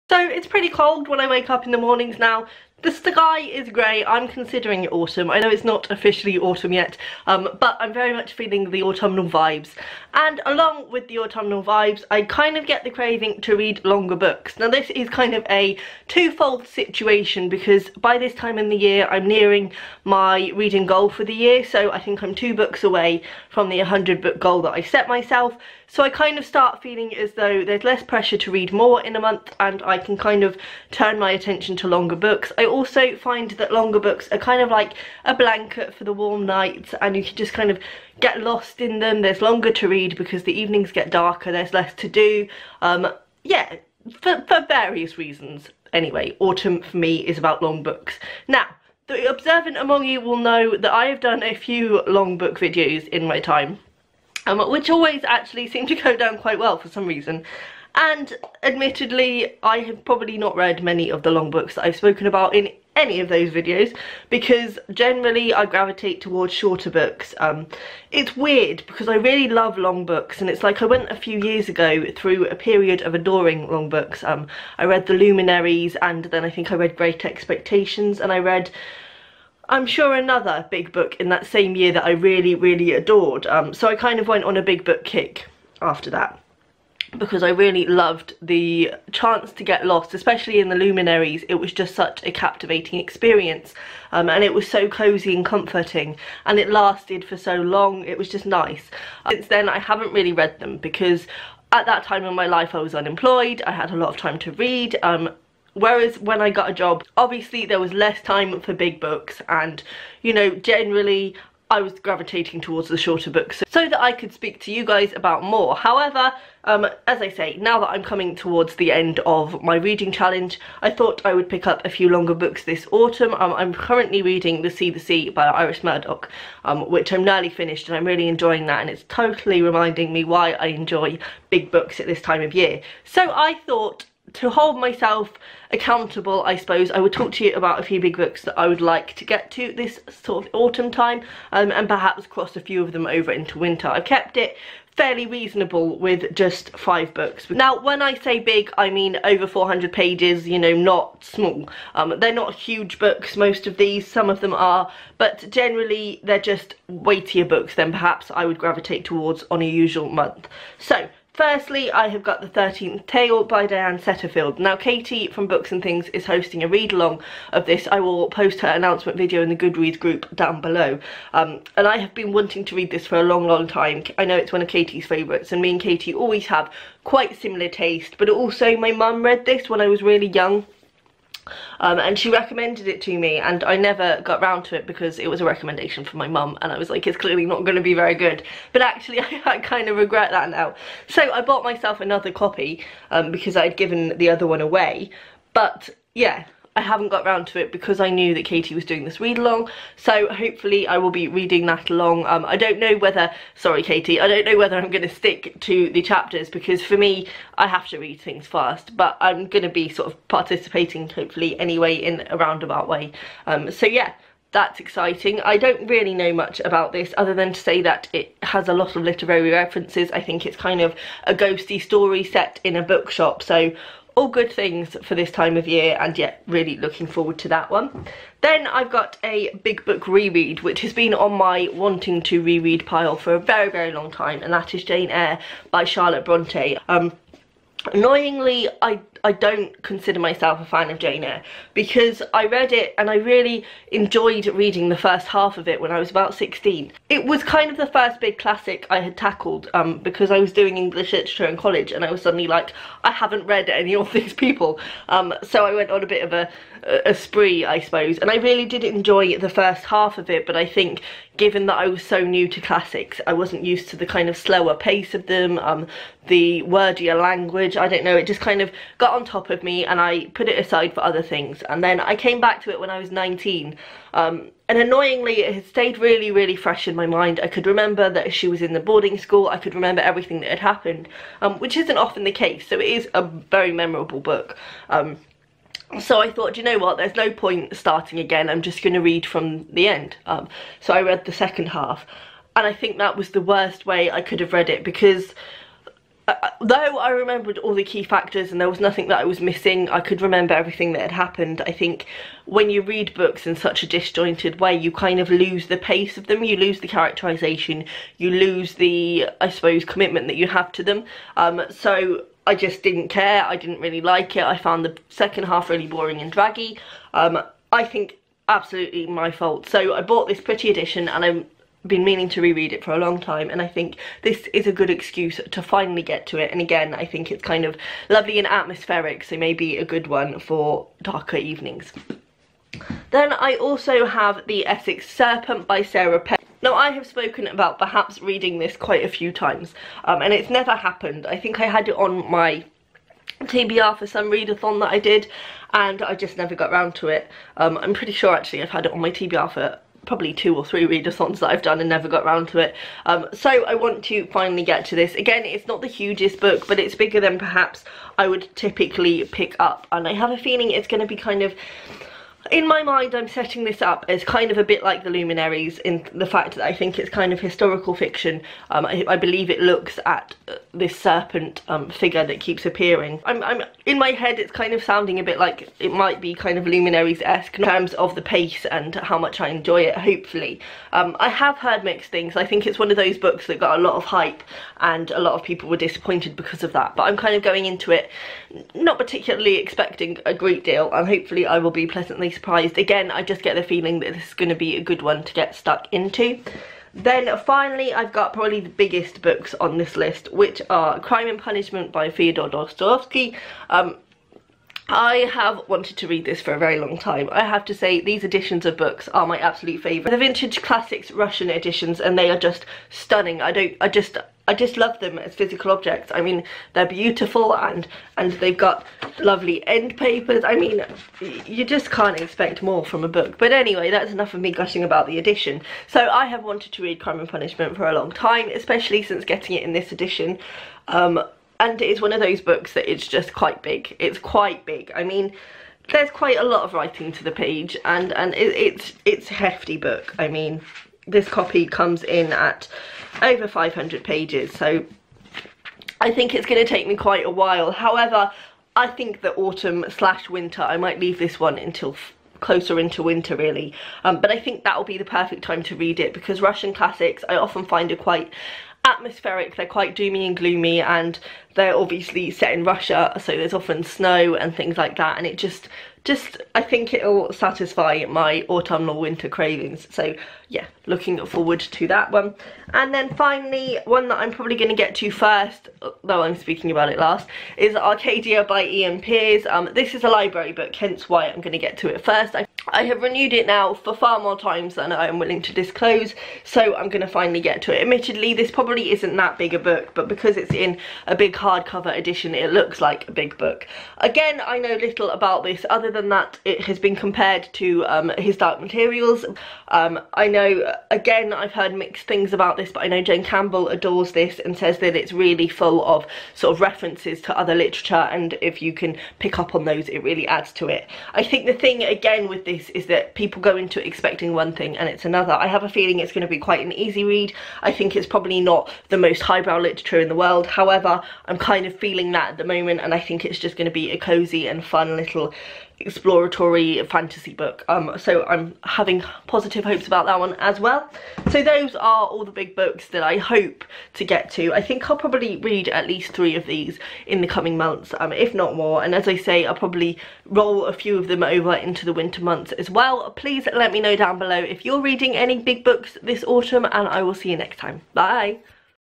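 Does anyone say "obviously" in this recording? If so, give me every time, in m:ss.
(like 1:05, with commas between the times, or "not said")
1:47, 7:41.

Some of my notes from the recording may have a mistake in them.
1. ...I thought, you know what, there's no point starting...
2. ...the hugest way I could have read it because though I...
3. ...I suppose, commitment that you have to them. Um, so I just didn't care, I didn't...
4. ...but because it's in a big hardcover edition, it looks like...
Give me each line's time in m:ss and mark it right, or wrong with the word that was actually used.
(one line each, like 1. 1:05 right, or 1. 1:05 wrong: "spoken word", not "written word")
1. 4:46 right
2. 4:53 wrong: "worst", not "hugest"
3. 5:09 right
4. 8:09 right.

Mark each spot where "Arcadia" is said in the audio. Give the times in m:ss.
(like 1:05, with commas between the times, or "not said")
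7:57.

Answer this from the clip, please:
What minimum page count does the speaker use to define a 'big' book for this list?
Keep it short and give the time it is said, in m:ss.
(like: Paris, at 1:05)
400, at 2:29.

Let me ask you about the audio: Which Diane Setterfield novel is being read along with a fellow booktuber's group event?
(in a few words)
The 13th Tale.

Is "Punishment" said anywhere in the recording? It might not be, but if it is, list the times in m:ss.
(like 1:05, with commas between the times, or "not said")
6:41, 7:07.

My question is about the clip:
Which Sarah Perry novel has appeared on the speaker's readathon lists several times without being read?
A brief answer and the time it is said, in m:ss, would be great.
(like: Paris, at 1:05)
The Essex Serpent, at 5:34.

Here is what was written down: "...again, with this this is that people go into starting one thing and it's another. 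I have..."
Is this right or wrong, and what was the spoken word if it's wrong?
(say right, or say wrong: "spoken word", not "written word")
wrong: "expecting", not "starting".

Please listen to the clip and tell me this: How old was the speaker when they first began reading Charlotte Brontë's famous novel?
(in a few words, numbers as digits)
16.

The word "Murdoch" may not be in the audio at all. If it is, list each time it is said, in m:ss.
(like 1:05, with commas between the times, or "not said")
2:05.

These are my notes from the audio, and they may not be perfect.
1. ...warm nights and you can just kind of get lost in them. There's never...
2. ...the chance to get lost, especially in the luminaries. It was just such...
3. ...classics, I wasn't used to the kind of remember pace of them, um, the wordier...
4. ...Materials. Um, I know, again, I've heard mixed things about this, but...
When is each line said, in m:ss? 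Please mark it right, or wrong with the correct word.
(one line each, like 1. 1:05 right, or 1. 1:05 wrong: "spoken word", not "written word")
1. 0:36 wrong: "longer", not "never"
2. 1:28 right
3. 4:22 wrong: "slower", not "remember"
4. 8:18 right.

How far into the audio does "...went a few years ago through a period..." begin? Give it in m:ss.
1:10.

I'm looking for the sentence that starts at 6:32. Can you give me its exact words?
Again, I just get the feeling that this is going to be a good one to get stuck into.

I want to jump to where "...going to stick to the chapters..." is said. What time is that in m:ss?
3:24.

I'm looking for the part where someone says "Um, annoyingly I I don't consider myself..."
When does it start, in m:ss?
3:56.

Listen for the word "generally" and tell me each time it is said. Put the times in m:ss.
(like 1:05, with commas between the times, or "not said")
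1:04, 1:50, 2:35.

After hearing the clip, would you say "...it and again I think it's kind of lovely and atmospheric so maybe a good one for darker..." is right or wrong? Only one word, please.
right.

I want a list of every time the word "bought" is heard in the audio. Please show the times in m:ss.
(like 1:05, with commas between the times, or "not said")
3:11, 5:20.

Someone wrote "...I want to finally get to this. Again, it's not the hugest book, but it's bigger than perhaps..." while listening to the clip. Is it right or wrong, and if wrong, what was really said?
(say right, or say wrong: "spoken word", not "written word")
right.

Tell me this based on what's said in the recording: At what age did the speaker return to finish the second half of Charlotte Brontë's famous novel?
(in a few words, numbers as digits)
19.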